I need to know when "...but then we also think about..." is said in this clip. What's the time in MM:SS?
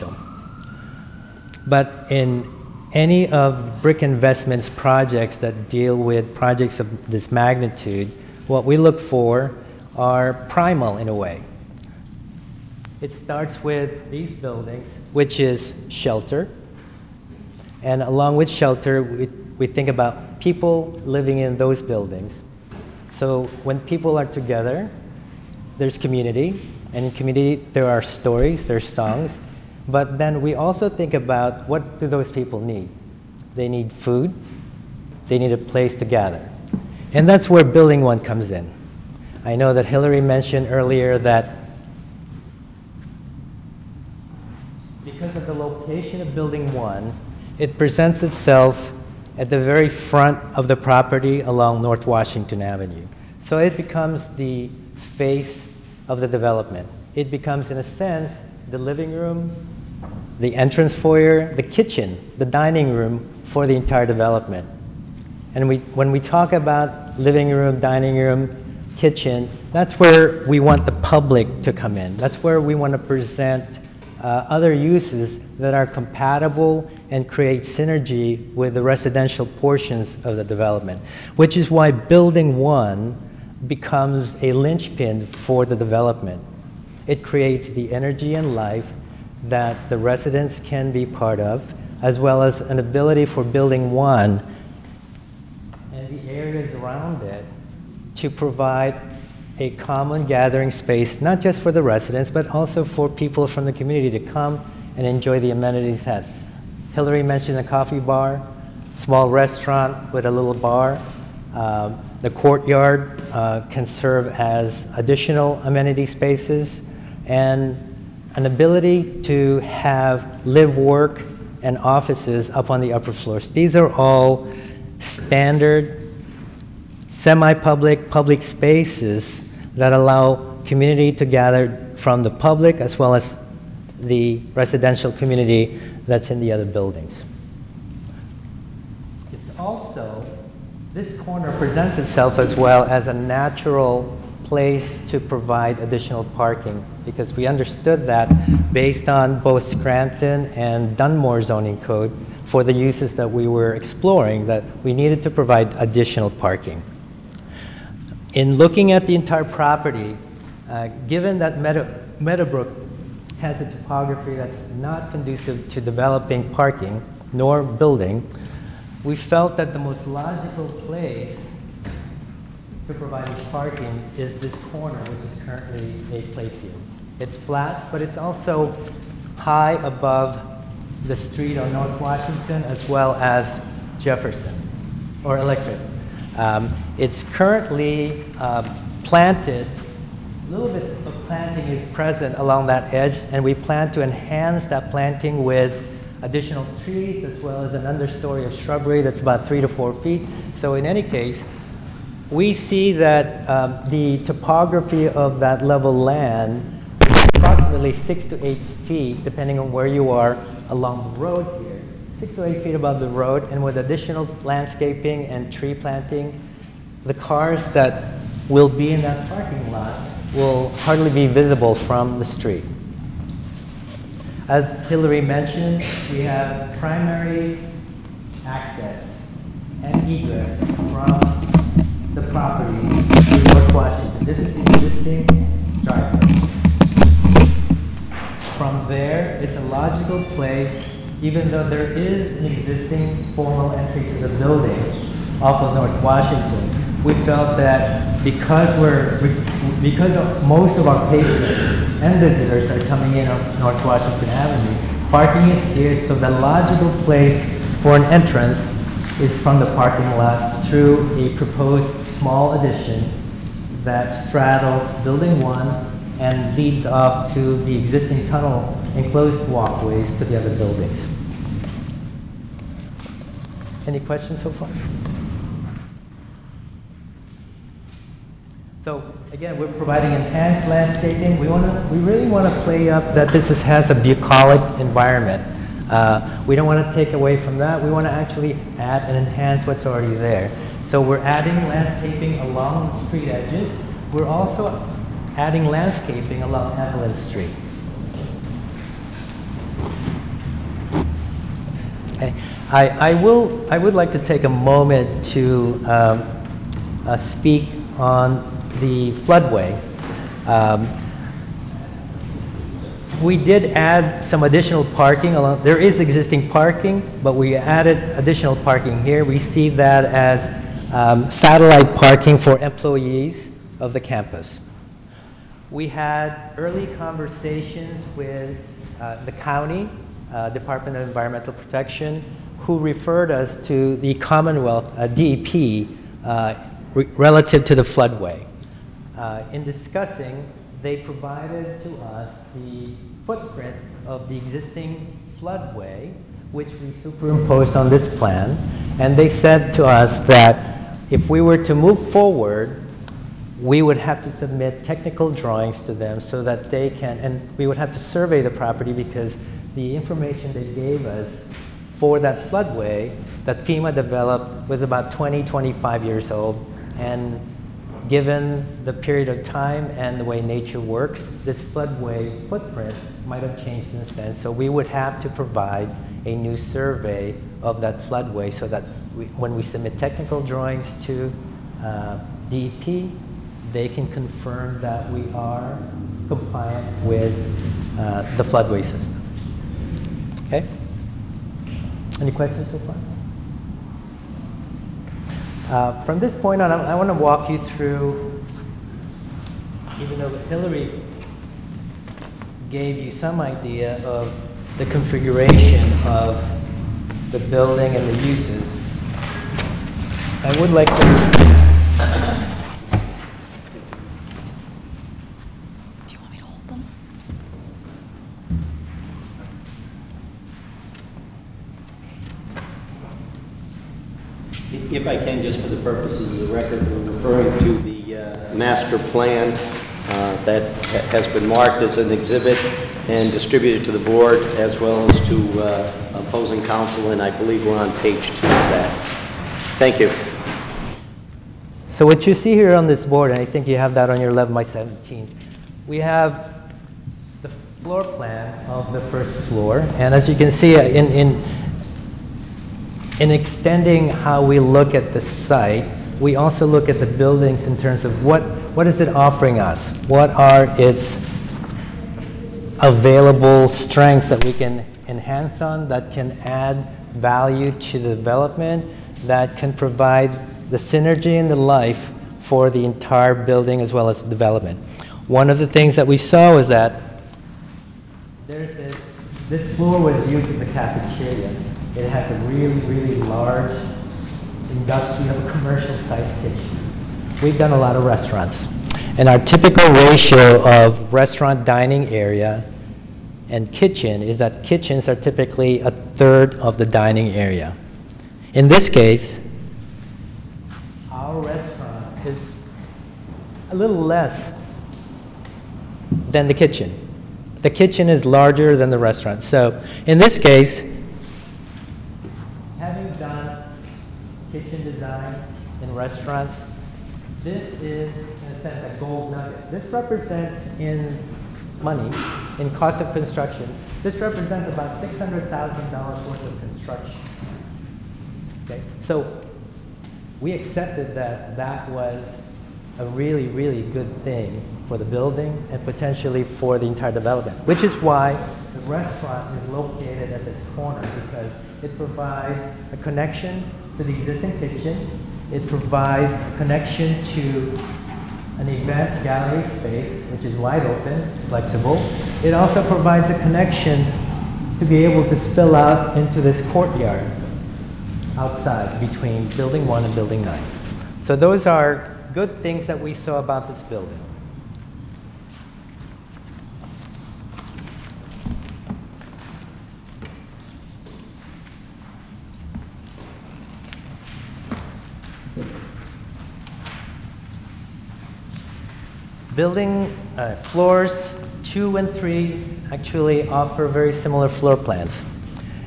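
00:29.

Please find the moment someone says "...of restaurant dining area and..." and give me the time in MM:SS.
08:10.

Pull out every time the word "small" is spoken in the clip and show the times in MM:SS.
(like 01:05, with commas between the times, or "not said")
01:48, 04:22.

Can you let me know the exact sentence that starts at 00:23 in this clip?
So when people are together, there's community.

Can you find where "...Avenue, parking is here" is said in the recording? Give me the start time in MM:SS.
04:14.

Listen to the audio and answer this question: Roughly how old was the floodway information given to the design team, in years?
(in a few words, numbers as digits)
20 to 25 years.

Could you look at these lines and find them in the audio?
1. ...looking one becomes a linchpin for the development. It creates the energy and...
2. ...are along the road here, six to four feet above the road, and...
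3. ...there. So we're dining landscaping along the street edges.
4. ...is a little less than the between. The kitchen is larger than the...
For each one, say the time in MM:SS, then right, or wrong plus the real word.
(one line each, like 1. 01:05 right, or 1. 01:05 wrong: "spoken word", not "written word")
1. 01:21 wrong: "building", not "looking"
2. 03:30 wrong: "eight", not "four"
3. 04:50 wrong: "adding", not "dining"
4. 08:22 wrong: "kitchen", not "between".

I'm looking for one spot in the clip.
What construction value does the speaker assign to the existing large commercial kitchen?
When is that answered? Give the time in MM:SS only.
08:45.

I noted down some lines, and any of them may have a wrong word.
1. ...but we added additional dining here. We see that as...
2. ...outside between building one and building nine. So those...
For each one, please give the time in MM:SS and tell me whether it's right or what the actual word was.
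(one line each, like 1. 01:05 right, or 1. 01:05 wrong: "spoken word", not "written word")
1. 05:17 wrong: "parking", not "dining"
2. 09:18 right.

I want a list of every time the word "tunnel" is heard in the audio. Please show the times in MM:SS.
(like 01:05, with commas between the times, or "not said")
04:28.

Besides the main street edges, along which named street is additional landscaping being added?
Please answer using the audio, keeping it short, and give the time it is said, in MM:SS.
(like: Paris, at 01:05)
Evelyn Street, at 04:56.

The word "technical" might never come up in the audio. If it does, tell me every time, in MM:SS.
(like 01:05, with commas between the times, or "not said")
05:54, 06:19.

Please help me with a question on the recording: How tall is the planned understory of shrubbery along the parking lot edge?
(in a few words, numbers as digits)
3 to 4 feet.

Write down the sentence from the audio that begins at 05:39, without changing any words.
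Uh, in discussing, they provided to us the footprint of the existing floodway, which we superimposed on this plan.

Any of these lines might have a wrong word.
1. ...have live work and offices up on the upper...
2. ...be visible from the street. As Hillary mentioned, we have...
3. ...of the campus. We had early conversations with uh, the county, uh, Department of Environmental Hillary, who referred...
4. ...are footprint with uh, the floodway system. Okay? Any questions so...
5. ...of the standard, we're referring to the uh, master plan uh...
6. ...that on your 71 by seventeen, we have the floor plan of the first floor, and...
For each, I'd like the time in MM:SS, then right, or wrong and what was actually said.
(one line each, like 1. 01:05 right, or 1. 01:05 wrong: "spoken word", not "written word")
1. 01:59 right
2. 03:41 right
3. 05:23 wrong: "Protection", not "Hillary"
4. 06:25 wrong: "compliant", not "footprint"
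5. 07:06 wrong: "record", not "standard"
6. 07:23 wrong: "11", not "71".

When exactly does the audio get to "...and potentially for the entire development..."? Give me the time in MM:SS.
08:55.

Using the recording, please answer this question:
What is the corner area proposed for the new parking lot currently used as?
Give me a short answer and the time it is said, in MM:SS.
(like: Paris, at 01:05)
A playfield, at 02:56.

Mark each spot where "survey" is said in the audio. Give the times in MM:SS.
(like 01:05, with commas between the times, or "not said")
05:57, 06:16.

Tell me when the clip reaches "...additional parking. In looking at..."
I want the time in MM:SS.
02:35.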